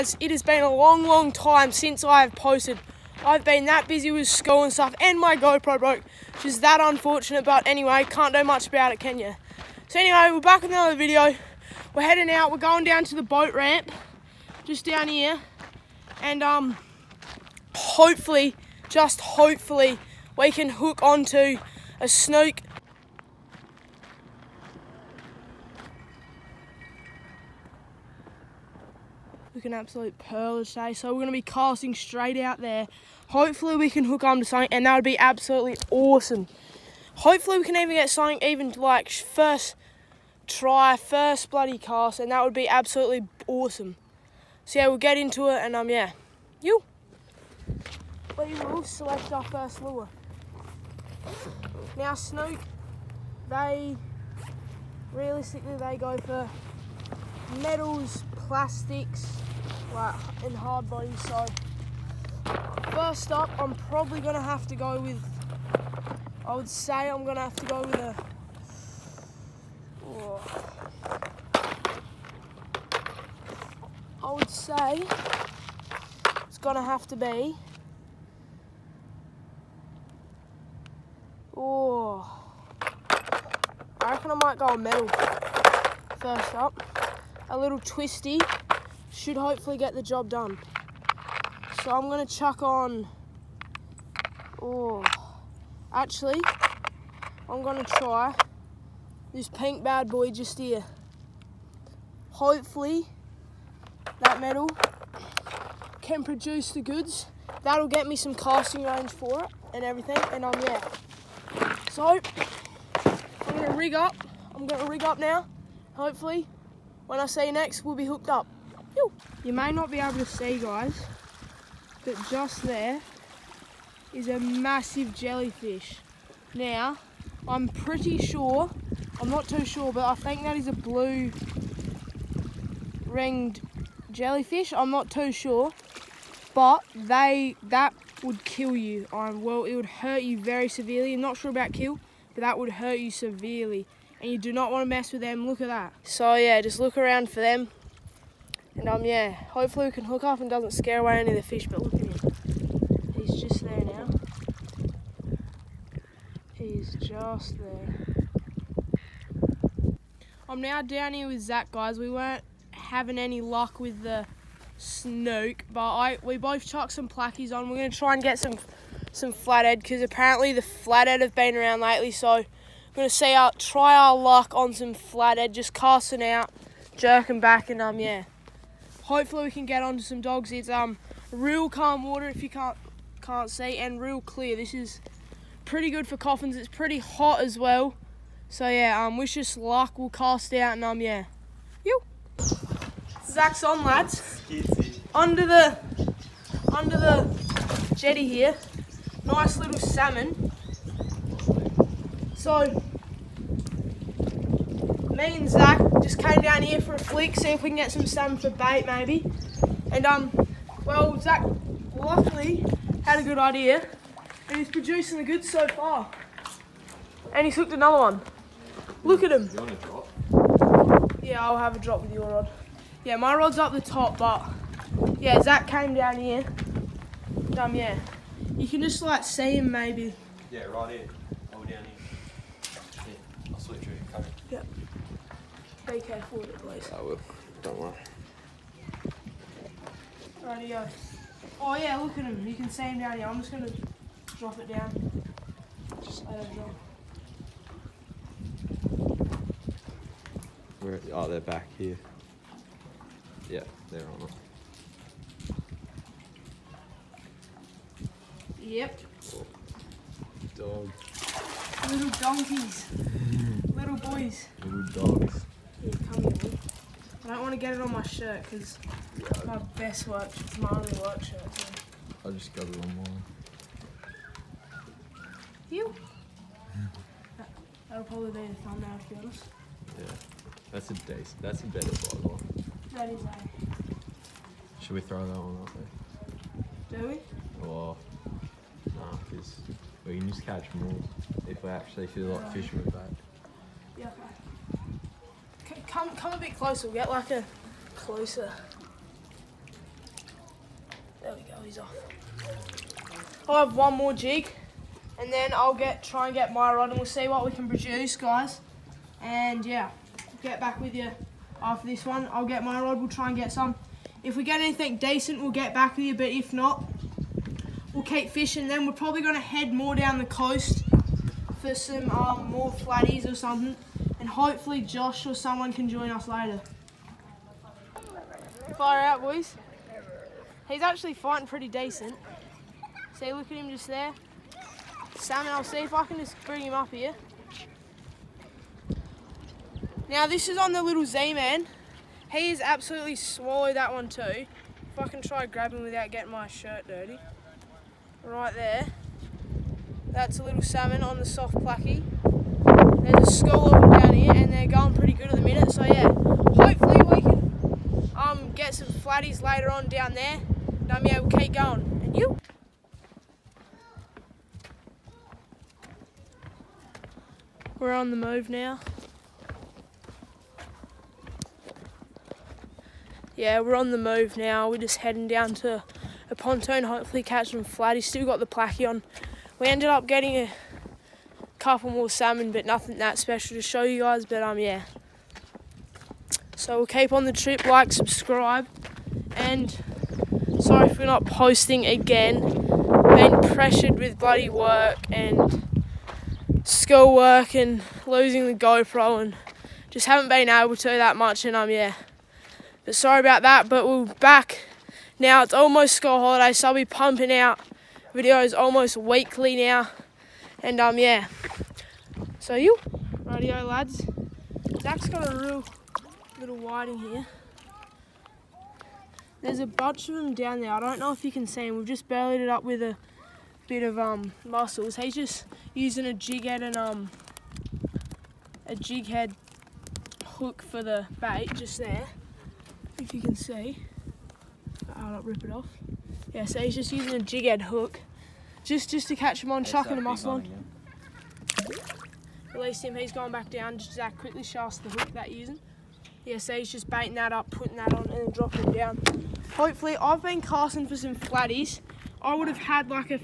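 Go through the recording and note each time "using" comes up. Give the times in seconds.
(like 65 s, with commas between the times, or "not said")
425 s, 436 s, 445 s.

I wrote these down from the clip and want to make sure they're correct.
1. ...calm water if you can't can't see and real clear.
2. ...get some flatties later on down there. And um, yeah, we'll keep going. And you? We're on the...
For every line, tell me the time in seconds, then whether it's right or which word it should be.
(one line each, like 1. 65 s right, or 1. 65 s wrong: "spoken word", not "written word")
1. 181 s right
2. 358 s right.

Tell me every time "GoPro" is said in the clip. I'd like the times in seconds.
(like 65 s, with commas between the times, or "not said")
5 s, 398 s.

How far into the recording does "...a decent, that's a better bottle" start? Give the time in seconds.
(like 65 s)
280 s.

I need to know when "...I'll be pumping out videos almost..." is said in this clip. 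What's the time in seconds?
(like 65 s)
406 s.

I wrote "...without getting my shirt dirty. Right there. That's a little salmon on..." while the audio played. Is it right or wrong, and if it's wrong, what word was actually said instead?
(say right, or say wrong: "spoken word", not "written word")
right.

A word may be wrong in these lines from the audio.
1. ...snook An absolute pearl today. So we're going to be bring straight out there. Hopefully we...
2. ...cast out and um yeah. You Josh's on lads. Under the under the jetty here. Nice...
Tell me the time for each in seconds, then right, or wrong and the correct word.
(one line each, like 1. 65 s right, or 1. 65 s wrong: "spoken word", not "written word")
1. 22 s wrong: "casting", not "bring"
2. 190 s wrong: "Zach", not "Josh".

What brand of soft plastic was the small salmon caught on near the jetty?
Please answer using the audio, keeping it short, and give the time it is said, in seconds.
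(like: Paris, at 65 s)
Z-Man, at 341 s.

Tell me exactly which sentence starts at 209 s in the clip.
And um, well, Zach luckily had a good idea and he's producing the goods so far.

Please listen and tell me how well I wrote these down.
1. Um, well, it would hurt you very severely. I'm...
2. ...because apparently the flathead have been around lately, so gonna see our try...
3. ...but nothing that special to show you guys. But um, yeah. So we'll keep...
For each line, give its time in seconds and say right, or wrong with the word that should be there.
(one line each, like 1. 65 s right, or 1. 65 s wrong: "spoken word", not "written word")
1. 139 s right
2. 169 s right
3. 382 s right.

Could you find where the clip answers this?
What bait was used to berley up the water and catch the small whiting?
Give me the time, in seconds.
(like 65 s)
424 s.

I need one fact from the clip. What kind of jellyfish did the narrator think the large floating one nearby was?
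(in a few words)
Blue ringed jellyfish.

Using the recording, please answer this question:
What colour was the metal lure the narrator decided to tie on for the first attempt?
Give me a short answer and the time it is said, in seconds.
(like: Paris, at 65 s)
Pink, at 99 s.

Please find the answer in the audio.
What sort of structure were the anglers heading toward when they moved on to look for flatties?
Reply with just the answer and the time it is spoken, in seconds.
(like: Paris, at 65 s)
A pontoon, at 376 s.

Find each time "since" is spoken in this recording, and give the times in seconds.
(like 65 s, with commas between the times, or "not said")
1 s.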